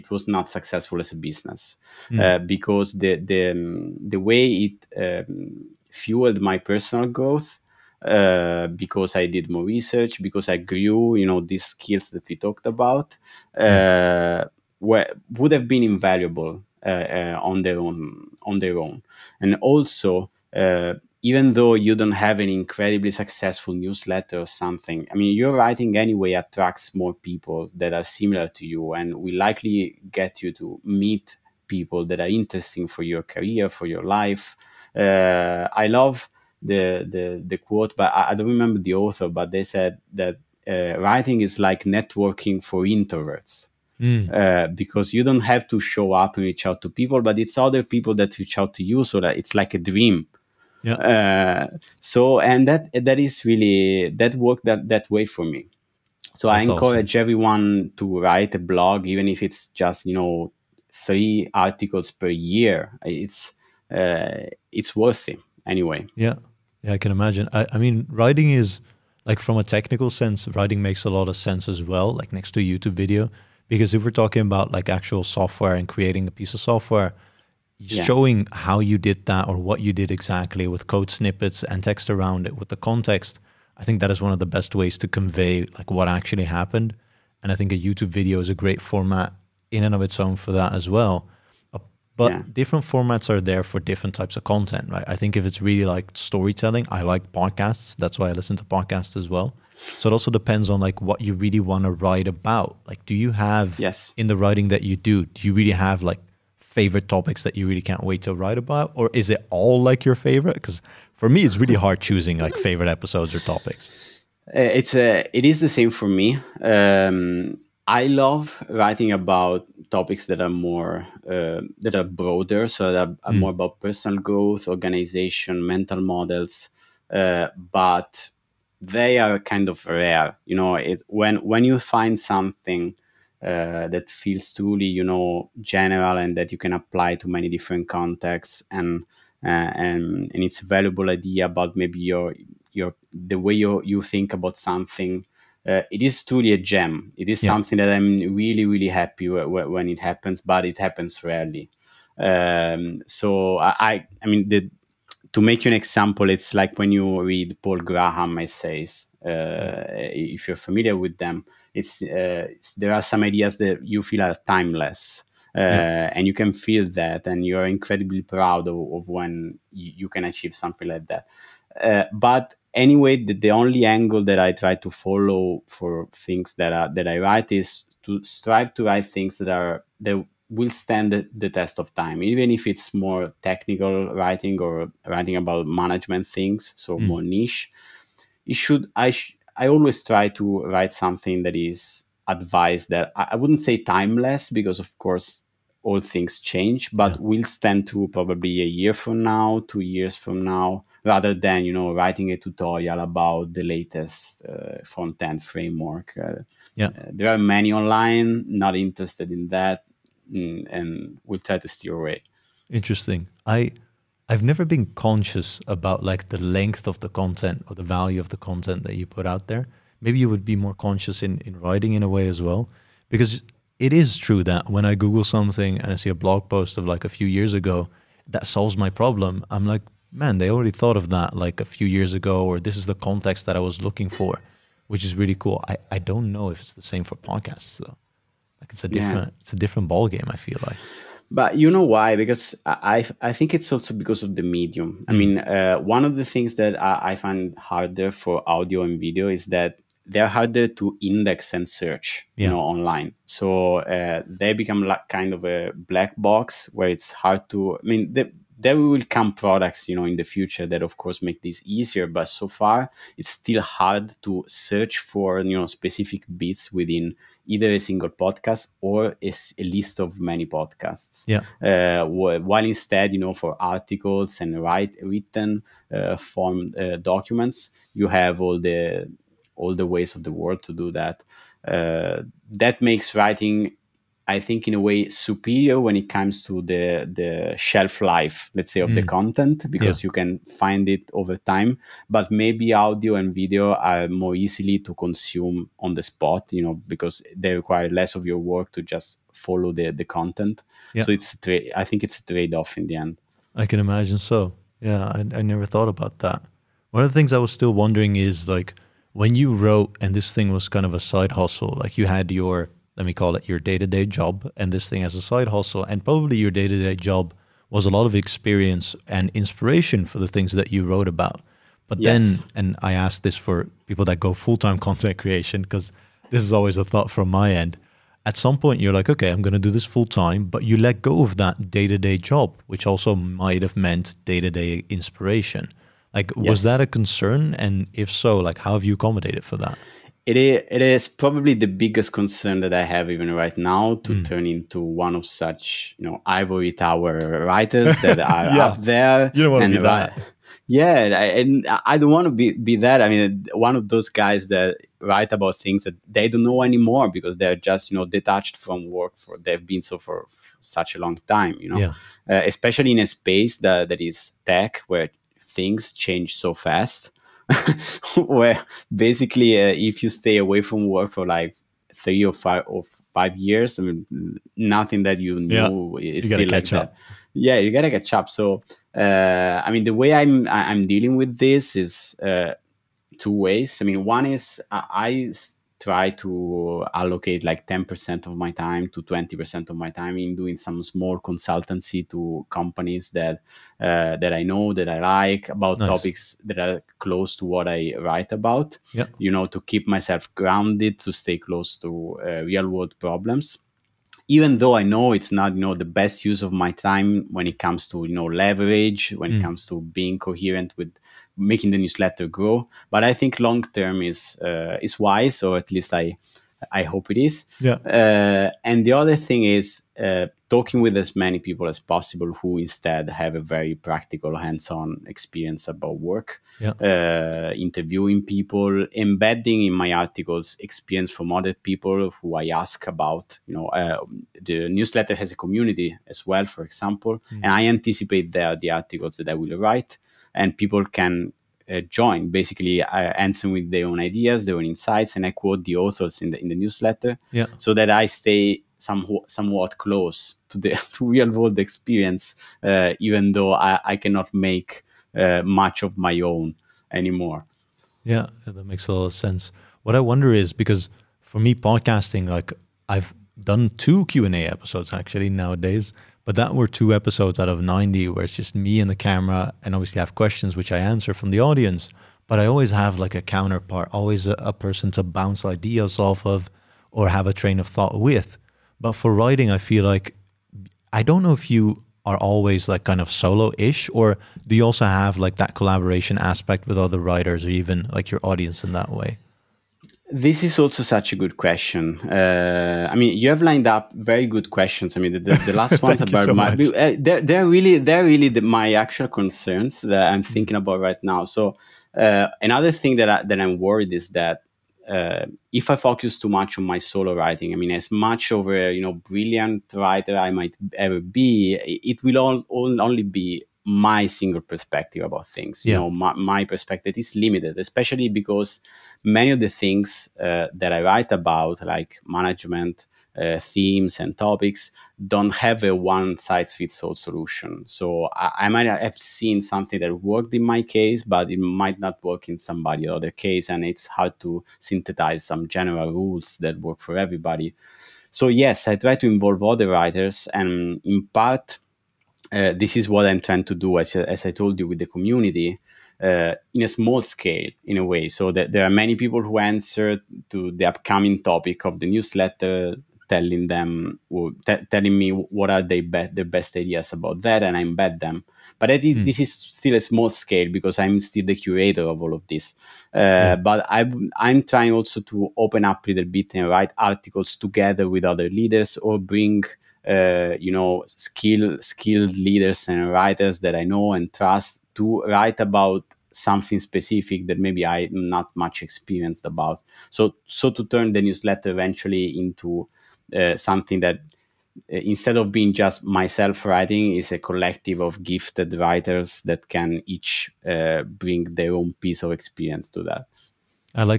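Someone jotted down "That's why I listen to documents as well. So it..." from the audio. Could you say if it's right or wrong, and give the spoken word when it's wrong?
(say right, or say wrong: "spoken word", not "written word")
wrong: "podcasts", not "documents".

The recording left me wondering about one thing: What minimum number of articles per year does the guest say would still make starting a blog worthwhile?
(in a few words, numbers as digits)
3.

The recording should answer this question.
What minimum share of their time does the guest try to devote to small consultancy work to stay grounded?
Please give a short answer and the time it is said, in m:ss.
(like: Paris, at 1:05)
10%, at 6:27.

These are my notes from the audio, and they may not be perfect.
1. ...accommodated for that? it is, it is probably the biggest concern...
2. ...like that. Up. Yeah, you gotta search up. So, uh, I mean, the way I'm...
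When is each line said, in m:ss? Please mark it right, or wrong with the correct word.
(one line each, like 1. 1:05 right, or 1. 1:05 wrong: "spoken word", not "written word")
1. 5:38 right
2. 6:16 wrong: "catch", not "search".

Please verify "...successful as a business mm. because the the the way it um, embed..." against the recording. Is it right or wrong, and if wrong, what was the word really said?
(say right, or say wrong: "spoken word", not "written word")
wrong: "fueled", not "embed".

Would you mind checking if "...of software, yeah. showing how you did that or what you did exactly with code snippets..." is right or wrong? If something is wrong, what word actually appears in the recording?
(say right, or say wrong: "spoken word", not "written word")
right.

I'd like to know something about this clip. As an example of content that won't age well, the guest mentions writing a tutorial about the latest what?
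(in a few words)
front end framework.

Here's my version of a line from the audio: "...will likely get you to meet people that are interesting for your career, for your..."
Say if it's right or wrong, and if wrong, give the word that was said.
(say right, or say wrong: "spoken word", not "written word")
right.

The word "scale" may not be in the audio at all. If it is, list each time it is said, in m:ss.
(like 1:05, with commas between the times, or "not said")
9:07, 9:20.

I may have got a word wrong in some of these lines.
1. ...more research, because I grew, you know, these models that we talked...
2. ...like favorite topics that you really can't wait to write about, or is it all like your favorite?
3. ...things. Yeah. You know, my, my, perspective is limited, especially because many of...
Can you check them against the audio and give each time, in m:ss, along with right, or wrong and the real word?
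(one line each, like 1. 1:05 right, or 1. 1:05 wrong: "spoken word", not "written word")
1. 0:09 wrong: "skills", not "models"
2. 1:46 right
3. 8:35 right.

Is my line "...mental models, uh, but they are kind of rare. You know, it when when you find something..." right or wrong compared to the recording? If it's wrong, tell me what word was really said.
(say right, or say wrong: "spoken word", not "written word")
right.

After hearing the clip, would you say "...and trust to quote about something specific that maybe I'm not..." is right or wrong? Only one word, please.
wrong.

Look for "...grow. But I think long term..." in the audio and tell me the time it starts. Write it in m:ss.
6:52.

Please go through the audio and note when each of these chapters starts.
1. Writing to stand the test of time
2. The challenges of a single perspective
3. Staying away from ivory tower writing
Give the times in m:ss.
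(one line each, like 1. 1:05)
1. 1:42
2. 7:39
3. 5:06.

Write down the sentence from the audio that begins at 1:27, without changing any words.
And I think a YouTube video is a great format in and of its own for that as well.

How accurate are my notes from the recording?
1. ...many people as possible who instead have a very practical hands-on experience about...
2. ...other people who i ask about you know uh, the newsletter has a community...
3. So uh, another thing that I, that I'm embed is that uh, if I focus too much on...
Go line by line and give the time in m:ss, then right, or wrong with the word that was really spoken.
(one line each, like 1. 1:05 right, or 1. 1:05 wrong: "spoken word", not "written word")
1. 7:01 right
2. 7:11 right
3. 8:21 wrong: "worried", not "embed".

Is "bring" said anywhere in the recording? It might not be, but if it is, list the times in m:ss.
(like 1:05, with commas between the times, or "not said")
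9:29, 9:50.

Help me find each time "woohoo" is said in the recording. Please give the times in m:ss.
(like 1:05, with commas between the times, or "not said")
not said.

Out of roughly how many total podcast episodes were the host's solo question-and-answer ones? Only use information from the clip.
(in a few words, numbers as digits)
90.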